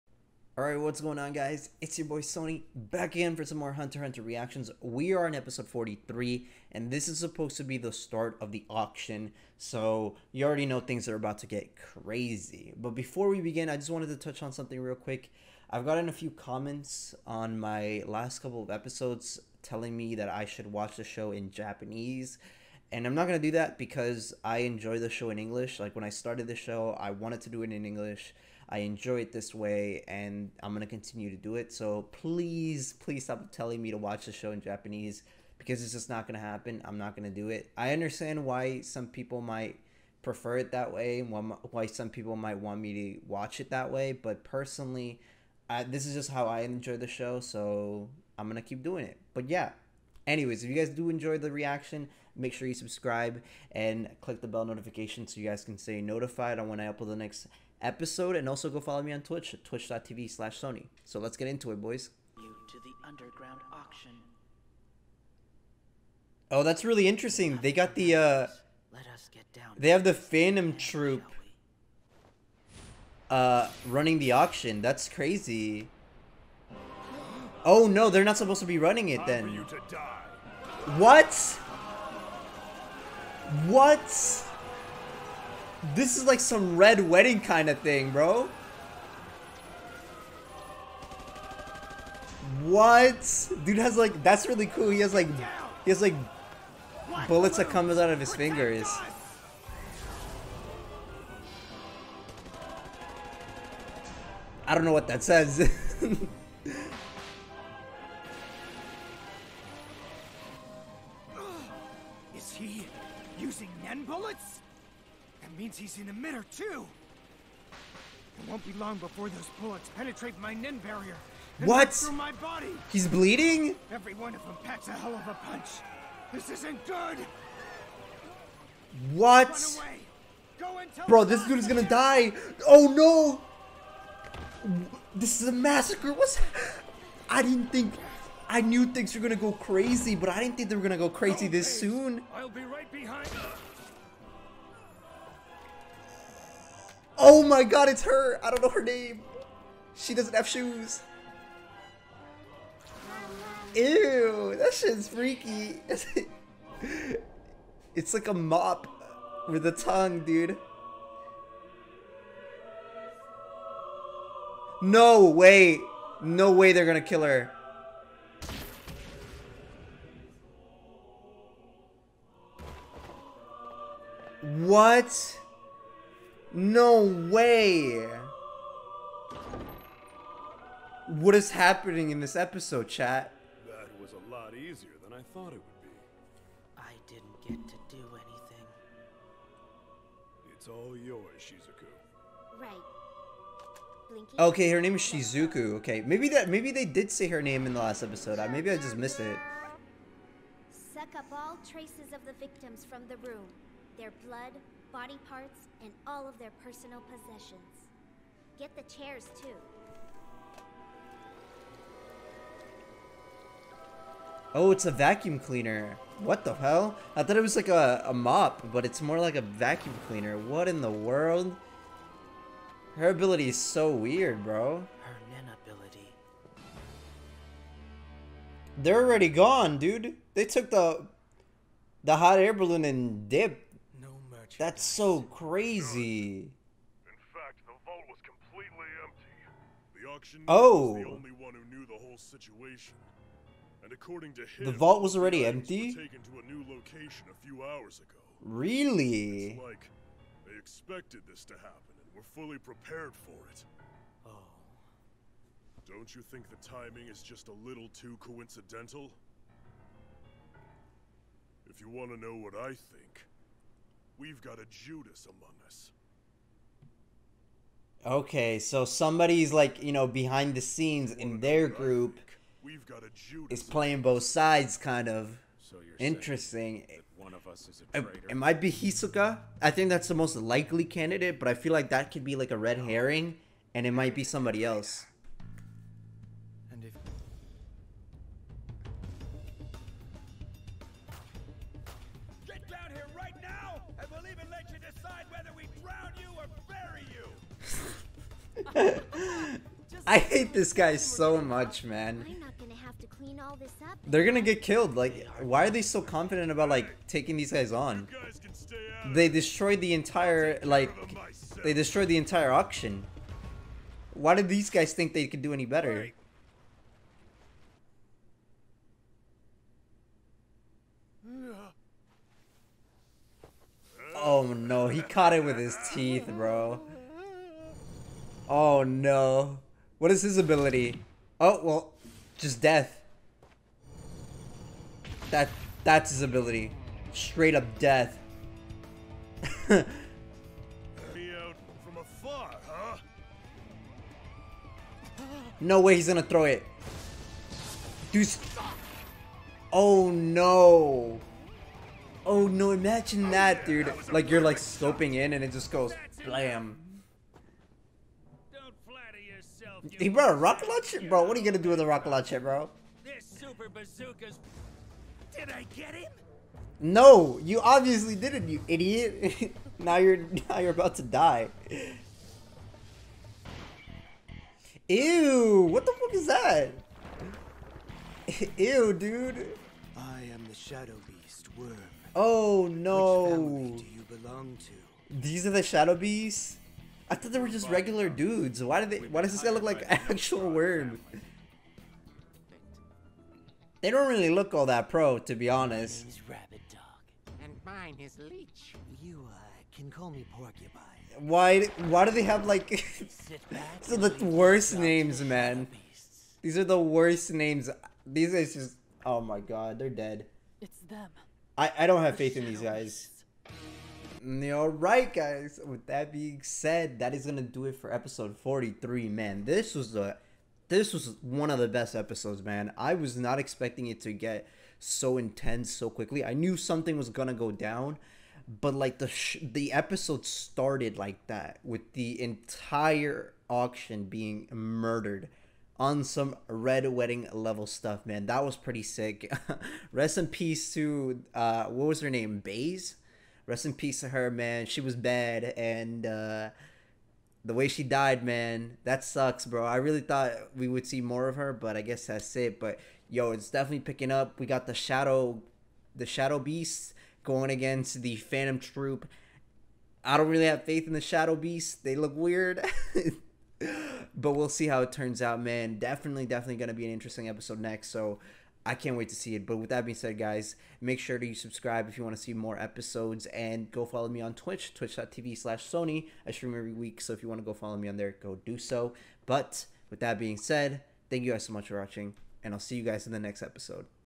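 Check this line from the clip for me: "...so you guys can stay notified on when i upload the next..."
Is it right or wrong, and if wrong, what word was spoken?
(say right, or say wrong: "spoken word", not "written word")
right.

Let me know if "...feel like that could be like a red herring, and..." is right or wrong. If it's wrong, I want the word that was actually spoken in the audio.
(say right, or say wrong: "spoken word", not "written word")
right.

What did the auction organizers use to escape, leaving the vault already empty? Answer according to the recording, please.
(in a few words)
hot air balloon.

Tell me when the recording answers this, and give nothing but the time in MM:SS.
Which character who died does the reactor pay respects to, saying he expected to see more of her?
07:22.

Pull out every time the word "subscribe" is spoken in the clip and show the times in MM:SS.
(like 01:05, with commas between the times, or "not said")
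00:52, 07:51.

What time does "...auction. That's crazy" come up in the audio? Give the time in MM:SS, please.
01:14.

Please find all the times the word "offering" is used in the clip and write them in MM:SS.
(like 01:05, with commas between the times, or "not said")
not said.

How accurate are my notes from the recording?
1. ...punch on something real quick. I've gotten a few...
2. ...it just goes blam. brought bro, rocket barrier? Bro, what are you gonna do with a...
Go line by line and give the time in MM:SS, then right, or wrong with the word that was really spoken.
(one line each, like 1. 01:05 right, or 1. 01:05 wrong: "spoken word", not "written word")
1. 00:14 wrong: "touch", not "punch"
2. 05:55 wrong: "launcher", not "barrier".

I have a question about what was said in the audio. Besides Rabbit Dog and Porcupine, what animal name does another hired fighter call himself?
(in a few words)
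Leech.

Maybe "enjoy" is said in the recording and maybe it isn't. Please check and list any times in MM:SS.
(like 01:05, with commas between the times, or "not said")
00:24, 00:28, 00:46, 00:51.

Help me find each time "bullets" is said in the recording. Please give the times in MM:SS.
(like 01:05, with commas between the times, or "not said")
01:37, 01:59.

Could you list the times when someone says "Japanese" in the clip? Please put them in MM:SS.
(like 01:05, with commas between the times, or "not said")
00:21, 00:34.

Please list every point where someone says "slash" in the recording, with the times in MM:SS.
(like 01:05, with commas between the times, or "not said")
01:00, 07:55.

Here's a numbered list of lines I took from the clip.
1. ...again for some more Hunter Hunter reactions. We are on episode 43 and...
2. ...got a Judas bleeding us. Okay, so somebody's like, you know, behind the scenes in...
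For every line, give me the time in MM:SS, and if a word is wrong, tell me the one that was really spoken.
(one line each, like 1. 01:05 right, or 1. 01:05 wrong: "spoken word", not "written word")
1. 00:03 right
2. 04:24 wrong: "among", not "bleeding".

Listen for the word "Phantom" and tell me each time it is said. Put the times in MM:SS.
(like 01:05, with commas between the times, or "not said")
01:10, 07:38.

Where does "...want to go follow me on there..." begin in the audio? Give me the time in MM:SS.
07:57.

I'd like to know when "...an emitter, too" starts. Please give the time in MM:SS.
01:56.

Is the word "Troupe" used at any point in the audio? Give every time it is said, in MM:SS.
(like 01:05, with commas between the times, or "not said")
01:10, 07:38.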